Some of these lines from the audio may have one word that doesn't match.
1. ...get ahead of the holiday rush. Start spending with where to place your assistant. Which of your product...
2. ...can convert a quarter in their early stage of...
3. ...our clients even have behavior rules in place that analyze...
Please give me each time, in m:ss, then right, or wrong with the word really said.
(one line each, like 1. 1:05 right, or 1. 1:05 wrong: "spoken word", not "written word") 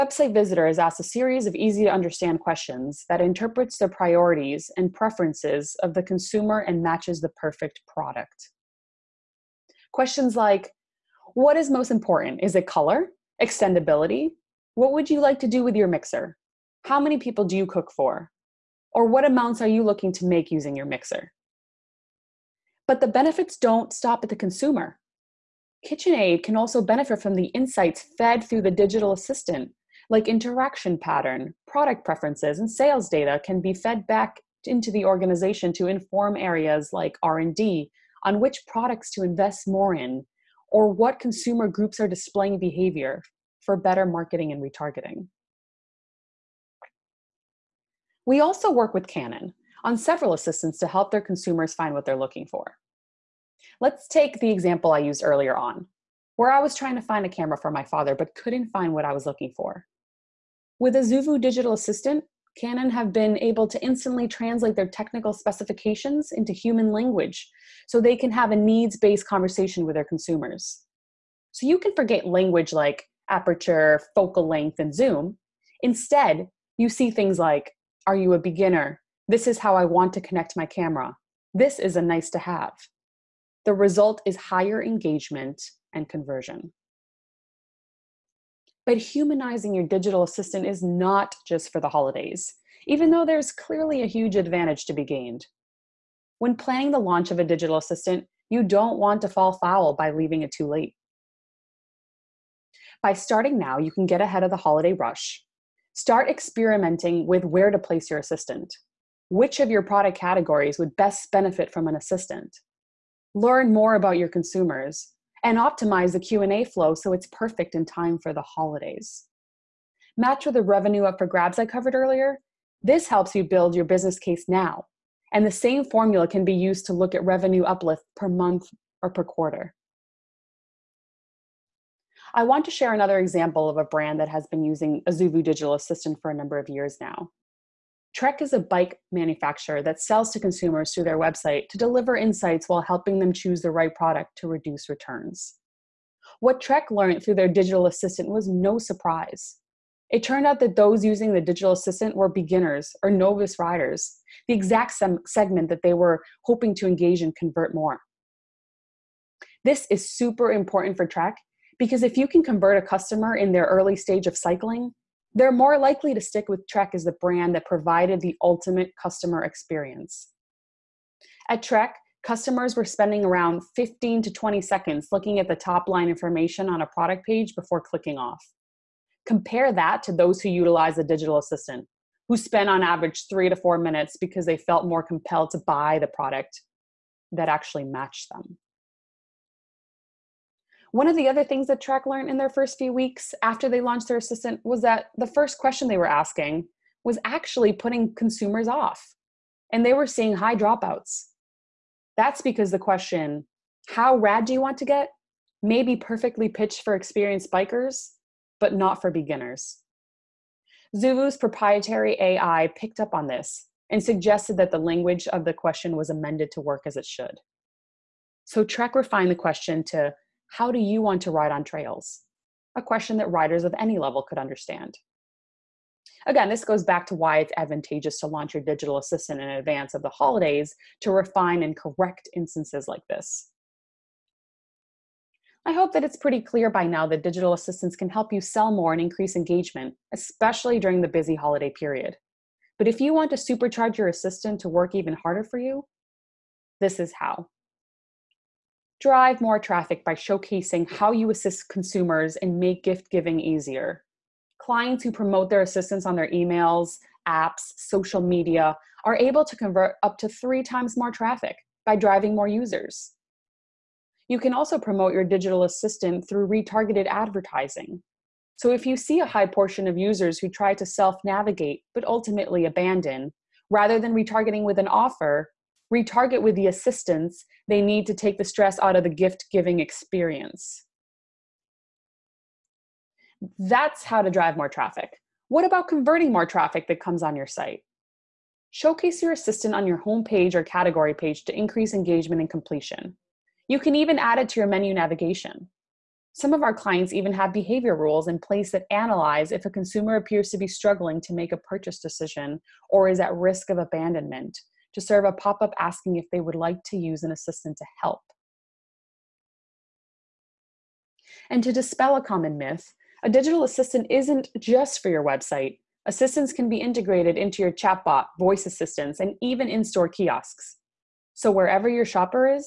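1. 1:44 wrong: "experimenting", not "spending"
2. 2:42 wrong: "customer", not "quarter"
3. 4:56 right.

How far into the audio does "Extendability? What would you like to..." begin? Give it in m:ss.
0:13.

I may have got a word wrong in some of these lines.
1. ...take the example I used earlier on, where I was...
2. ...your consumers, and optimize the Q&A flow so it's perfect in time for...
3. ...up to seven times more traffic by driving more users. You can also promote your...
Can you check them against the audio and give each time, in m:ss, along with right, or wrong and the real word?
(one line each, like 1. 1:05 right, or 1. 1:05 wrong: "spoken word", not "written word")
1. 0:54 right
2. 1:54 right
3. 4:20 wrong: "three", not "seven".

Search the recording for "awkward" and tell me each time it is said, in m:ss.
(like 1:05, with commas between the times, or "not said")
not said.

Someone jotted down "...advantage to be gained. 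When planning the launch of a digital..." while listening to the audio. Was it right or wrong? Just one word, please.
right.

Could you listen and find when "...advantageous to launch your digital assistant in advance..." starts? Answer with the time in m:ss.
3:47.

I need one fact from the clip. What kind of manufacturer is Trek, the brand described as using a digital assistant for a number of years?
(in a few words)
Bike manufacturer.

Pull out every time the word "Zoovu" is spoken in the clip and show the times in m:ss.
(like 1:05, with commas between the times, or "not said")
1:00, 3:30.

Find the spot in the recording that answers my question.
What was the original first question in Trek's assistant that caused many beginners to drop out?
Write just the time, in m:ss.
3:23.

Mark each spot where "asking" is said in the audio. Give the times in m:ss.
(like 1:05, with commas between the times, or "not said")
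3:16, 5:05.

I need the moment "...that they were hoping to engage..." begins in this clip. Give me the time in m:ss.
2:35.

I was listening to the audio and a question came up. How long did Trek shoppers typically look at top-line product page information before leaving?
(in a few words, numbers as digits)
15 to 20 seconds.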